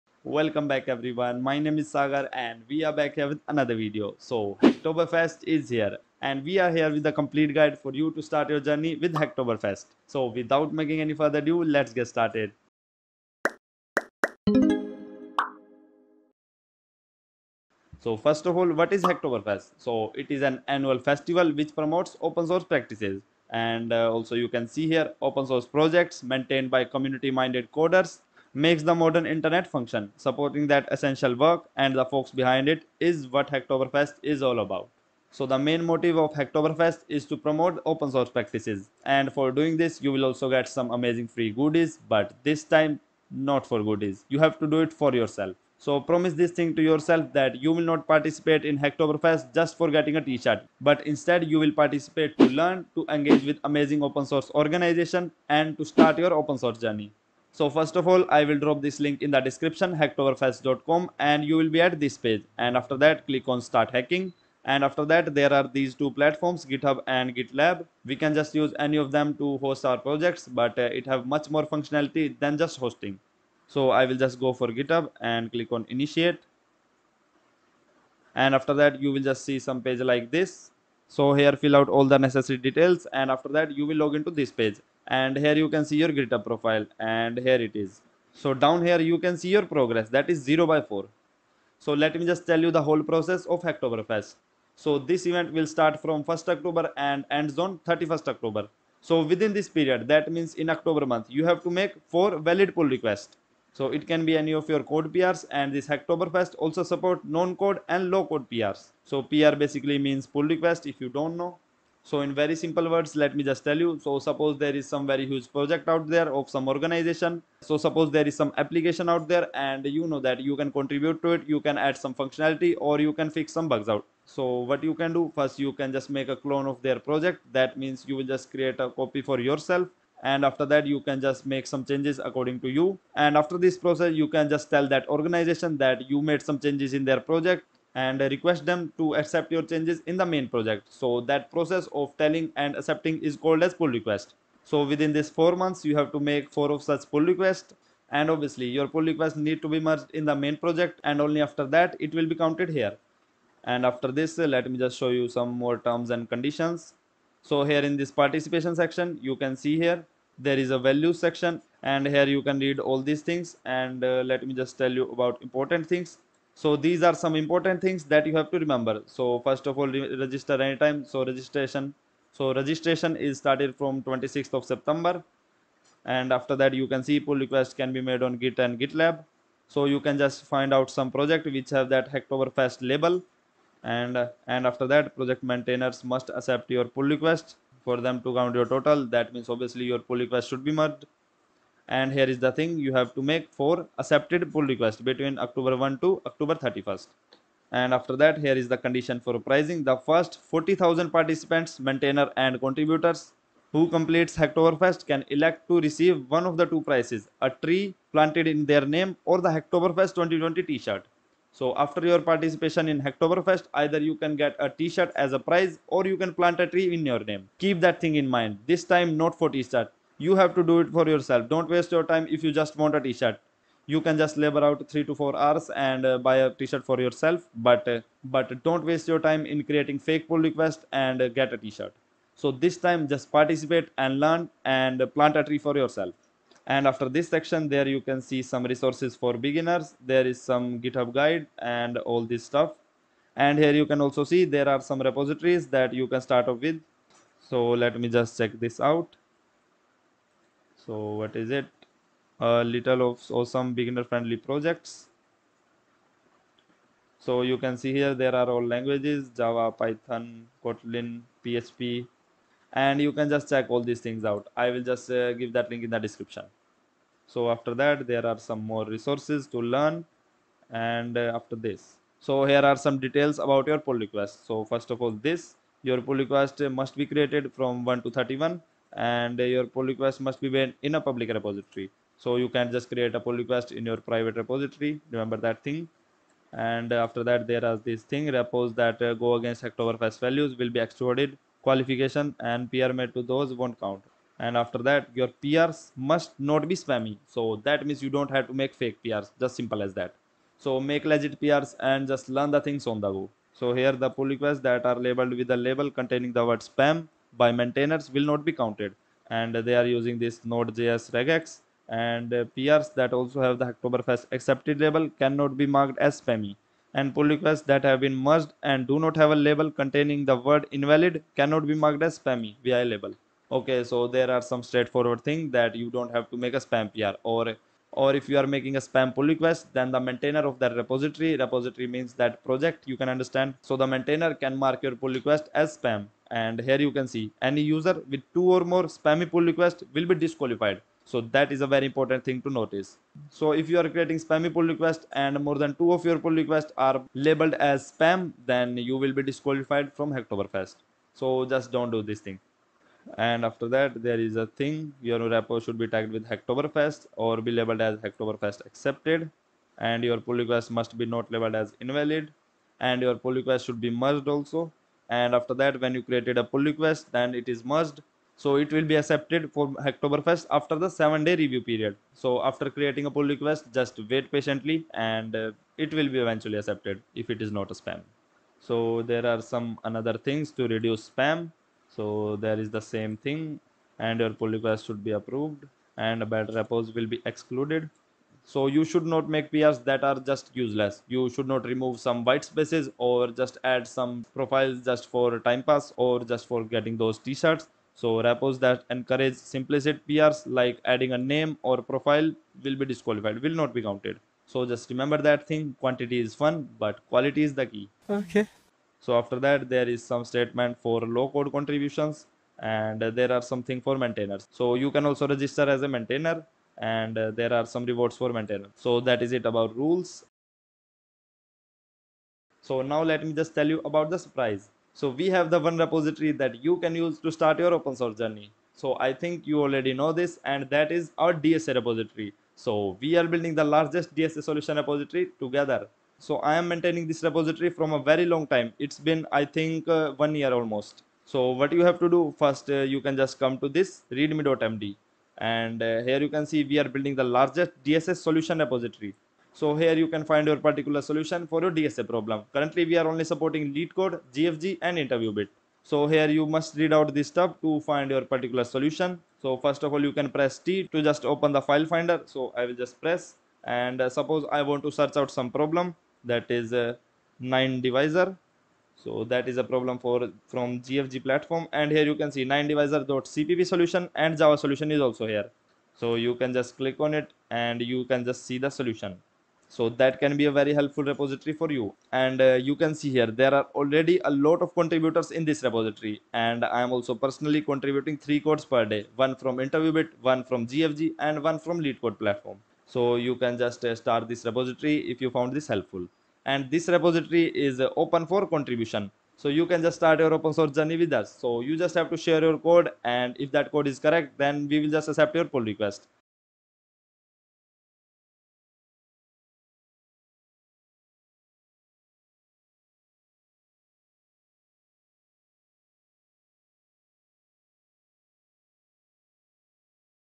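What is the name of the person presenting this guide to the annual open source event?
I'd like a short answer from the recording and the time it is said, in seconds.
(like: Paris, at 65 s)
Sagar, at 1 s.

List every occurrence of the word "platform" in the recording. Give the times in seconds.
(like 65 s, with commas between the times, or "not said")
66 s, 471 s, 492 s.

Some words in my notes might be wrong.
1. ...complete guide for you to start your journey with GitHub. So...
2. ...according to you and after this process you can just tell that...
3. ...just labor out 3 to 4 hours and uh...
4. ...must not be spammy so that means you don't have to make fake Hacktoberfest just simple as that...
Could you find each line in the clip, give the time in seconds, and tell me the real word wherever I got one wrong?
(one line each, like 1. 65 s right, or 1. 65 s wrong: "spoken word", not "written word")
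1. 7 s wrong: "Hacktoberfest", not "GitHub"
2. 132 s right
3. 224 s right
4. 295 s wrong: "PRs", not "Hacktoberfest".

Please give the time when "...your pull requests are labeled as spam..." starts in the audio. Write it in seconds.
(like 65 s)
346 s.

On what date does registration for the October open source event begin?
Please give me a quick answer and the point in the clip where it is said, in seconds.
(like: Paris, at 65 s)
26th of September, at 174 s.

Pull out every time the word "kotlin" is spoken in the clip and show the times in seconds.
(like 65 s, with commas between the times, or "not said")
260 s.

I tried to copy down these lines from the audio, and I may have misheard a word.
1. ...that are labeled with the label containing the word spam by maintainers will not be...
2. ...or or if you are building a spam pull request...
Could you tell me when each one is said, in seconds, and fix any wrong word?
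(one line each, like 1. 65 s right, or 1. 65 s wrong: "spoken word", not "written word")
1. 304 s right
2. 327 s wrong: "making", not "building".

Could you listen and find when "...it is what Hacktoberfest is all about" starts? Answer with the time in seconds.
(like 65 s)
32 s.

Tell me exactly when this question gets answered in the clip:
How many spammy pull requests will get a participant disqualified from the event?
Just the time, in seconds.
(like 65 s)
338 s.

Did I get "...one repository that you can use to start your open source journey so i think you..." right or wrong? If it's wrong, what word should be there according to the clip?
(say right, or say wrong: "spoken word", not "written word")
right.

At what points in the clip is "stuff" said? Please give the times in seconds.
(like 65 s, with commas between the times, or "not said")
242 s, 457 s.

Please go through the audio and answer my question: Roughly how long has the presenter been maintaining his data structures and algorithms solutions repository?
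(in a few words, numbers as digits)
one year.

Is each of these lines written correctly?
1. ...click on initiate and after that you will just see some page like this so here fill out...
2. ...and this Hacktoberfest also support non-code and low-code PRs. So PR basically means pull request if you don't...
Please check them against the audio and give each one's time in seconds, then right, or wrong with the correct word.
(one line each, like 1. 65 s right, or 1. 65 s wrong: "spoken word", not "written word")
1. 75 s right
2. 105 s right.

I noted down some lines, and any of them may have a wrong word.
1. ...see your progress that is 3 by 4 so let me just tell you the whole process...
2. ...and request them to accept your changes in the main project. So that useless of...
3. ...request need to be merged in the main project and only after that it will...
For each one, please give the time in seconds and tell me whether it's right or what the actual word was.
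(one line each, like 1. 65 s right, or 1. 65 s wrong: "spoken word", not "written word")
1. 89 s wrong: "0", not "3"
2. 137 s wrong: "process", not "useless"
3. 149 s right.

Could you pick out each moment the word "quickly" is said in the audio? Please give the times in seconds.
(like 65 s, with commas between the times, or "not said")
not said.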